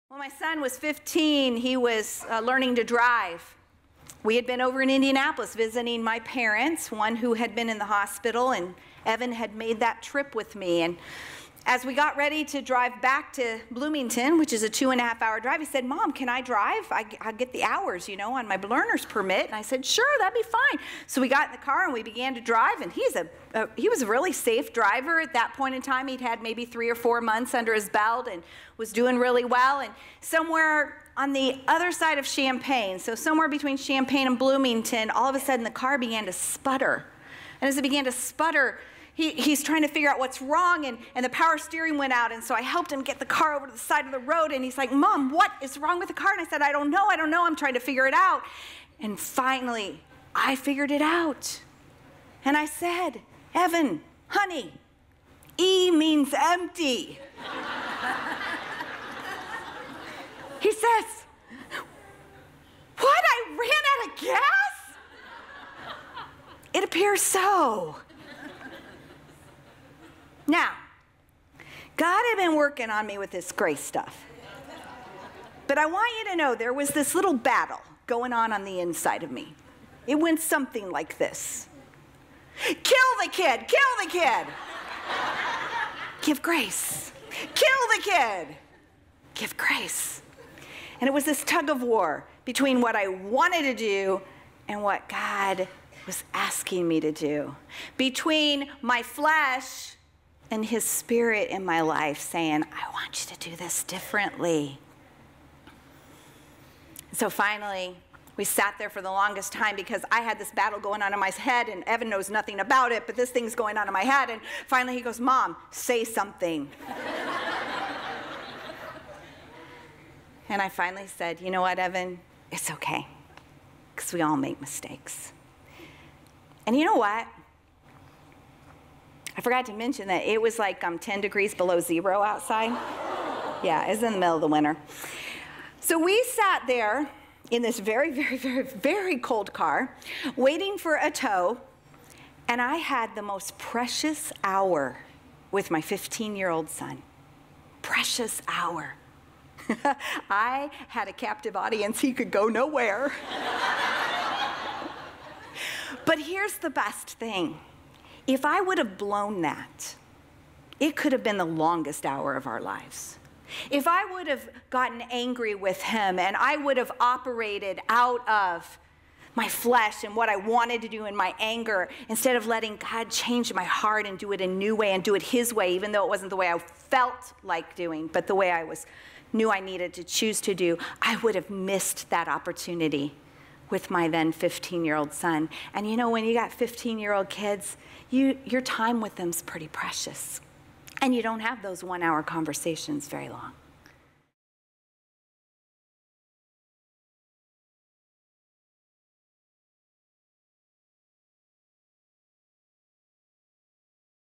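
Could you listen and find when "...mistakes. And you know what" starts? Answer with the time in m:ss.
2:04.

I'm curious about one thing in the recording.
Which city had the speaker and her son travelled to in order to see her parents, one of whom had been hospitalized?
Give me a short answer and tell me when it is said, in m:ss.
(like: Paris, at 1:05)
Indianapolis, at 0:04.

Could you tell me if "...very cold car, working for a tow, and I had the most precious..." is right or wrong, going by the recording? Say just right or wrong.
wrong.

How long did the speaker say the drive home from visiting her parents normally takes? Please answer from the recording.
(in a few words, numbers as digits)
2 and a half hours.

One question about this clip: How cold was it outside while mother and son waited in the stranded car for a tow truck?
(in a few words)
10 degrees below zero.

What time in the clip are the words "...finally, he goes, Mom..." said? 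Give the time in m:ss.
1:54.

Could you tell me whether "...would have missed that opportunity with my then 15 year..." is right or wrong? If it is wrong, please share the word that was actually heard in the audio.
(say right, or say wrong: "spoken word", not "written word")
right.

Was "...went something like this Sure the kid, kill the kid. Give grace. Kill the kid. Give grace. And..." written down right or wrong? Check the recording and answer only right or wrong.
wrong.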